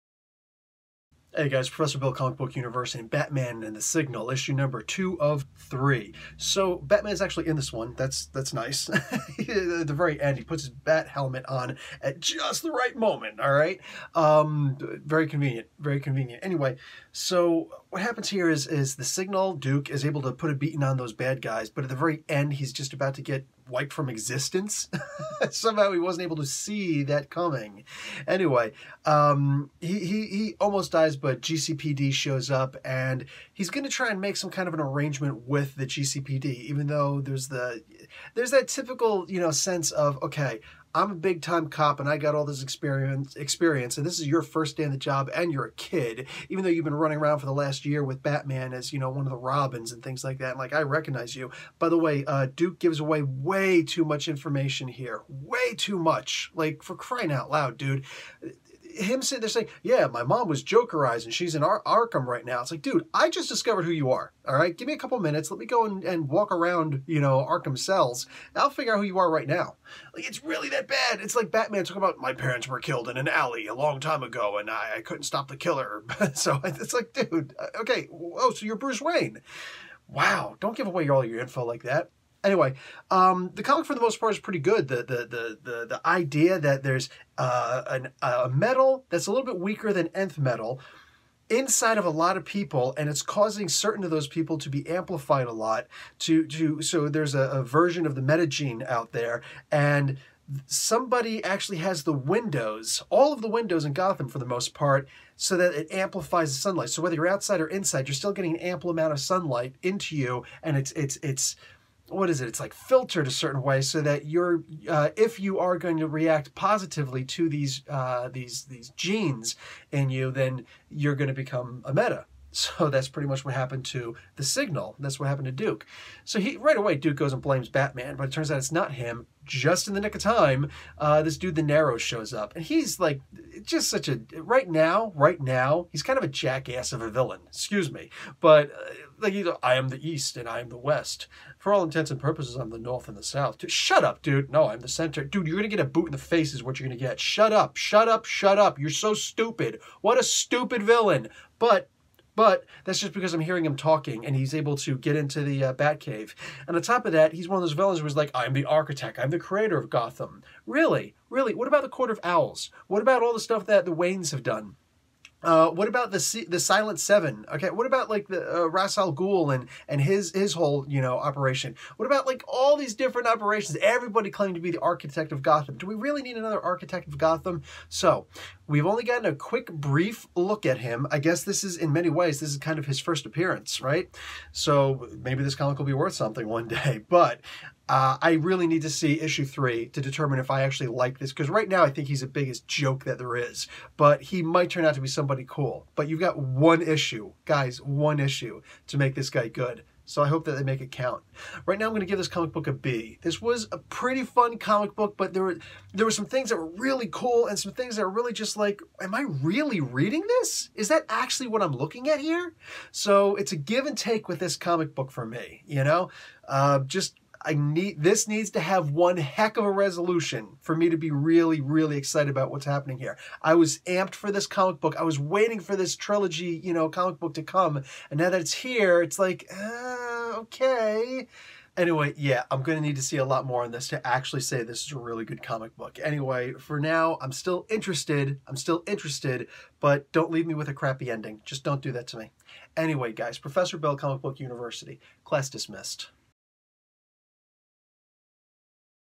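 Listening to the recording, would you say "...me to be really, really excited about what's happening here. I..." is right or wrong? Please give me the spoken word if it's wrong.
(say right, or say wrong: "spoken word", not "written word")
right.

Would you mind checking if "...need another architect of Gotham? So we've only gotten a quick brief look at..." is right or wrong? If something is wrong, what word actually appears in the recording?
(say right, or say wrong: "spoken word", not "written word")
right.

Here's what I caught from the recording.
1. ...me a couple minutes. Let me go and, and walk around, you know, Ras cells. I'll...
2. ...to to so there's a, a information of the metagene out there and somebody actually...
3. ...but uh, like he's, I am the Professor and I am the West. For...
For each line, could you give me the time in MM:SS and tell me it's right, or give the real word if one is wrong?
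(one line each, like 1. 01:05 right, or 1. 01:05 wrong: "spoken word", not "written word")
1. 01:04 wrong: "Arkham", not "Ras"
2. 01:36 wrong: "version", not "information"
3. 02:18 wrong: "East", not "Professor".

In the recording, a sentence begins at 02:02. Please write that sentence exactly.
So that's pretty much what happened to the signal.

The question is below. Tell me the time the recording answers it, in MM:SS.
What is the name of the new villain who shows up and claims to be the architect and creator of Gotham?
02:11.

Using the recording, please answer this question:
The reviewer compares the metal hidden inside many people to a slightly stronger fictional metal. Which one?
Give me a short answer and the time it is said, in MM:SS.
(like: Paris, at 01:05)
nth metal, at 01:30.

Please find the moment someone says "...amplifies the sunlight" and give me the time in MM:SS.
01:45.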